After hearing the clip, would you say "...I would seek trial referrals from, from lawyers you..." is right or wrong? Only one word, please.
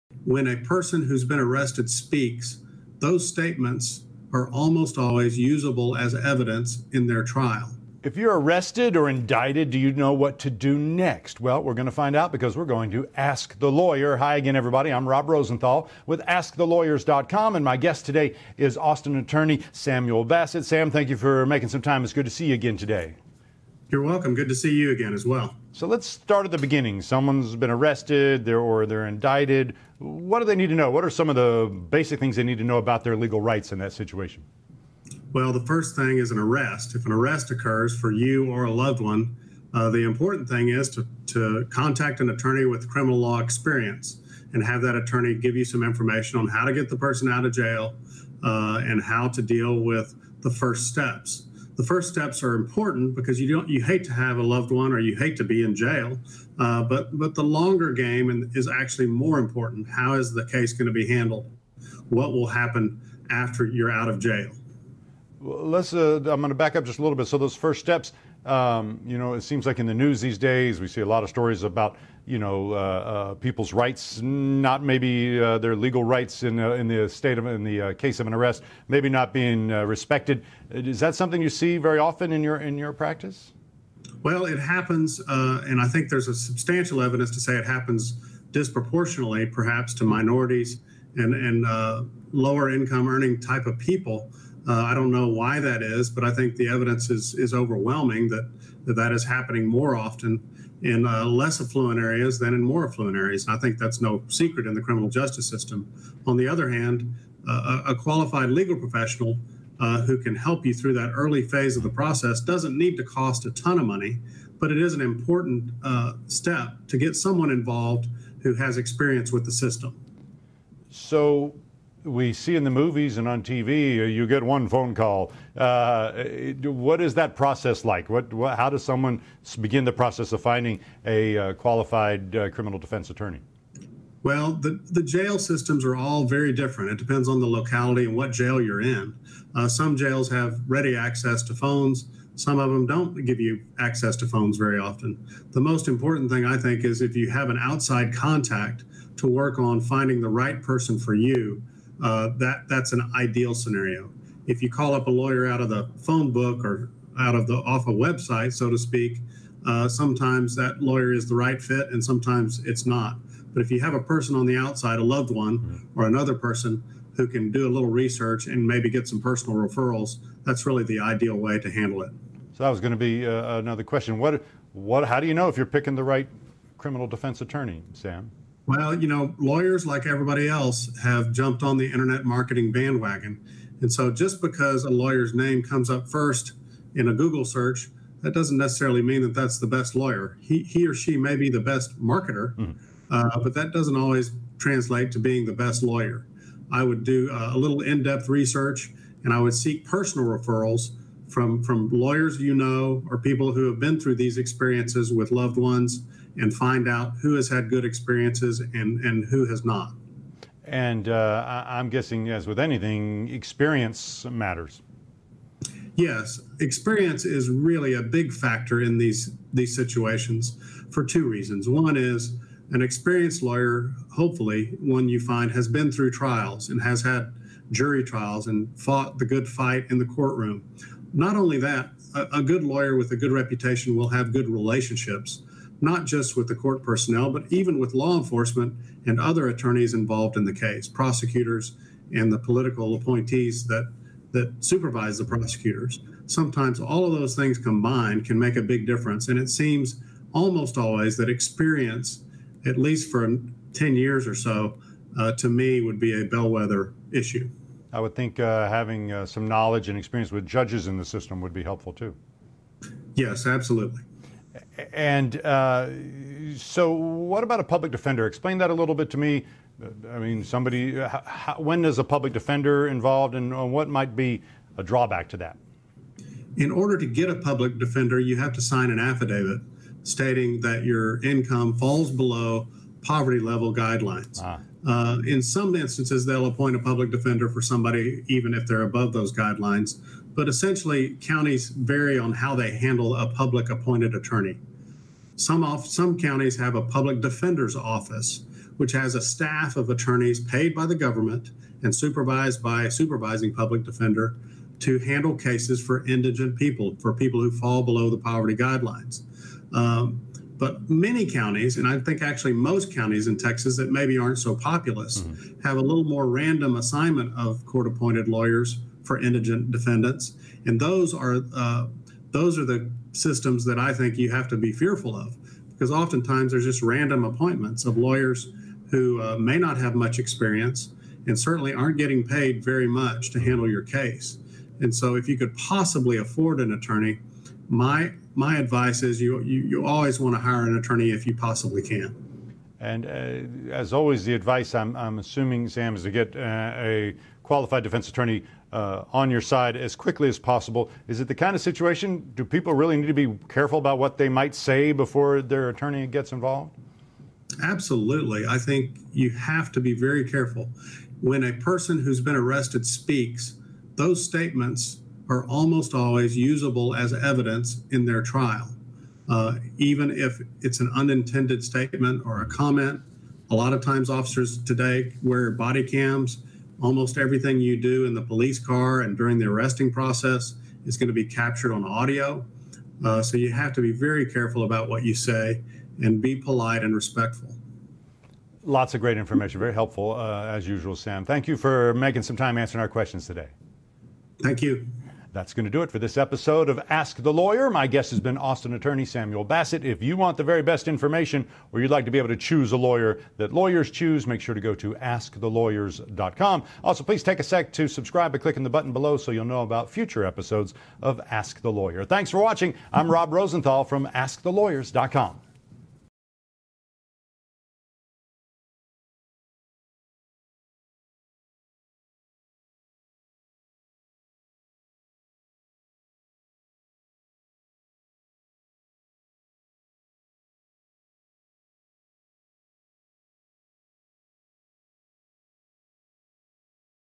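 wrong.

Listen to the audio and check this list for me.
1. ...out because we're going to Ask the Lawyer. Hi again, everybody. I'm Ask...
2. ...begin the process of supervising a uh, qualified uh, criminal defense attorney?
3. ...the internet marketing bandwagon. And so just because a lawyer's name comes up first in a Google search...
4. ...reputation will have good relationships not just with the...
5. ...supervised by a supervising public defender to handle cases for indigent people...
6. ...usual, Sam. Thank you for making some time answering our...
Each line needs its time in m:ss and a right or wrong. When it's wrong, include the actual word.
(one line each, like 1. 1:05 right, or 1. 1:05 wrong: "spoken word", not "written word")
1. 0:12 wrong: "Rob", not "Ask"
2. 2:09 wrong: "finding", not "supervising"
3. 3:01 right
4. 3:53 right
5. 5:01 right
6. 6:30 right.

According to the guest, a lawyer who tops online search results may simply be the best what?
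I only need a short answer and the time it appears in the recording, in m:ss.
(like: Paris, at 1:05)
marketer, at 3:12.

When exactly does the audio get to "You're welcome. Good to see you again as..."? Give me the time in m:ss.
0:23.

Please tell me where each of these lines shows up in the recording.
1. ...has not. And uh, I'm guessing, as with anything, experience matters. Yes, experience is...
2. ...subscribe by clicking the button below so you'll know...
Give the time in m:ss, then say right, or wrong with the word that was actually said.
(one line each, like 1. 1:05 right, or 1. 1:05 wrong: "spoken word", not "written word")
1. 3:29 right
2. 6:47 right.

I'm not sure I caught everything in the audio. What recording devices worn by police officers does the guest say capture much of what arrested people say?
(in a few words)
body cams.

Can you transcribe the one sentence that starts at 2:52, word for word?
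So that was going to be uh, another question.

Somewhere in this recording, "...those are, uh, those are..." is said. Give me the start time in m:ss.
5:20.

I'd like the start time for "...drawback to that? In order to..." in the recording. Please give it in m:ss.
4:34.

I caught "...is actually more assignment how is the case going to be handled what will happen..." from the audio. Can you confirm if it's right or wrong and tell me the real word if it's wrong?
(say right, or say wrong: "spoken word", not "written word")
wrong: "important", not "assignment".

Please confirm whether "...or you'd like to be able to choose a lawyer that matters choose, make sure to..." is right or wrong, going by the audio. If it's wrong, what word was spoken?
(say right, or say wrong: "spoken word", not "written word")
wrong: "lawyers", not "matters".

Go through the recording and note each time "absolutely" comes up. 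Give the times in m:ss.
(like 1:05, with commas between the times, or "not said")
4:23, 5:57.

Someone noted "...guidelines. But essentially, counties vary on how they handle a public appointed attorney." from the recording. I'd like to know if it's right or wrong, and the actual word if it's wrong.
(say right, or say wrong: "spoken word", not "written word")
right.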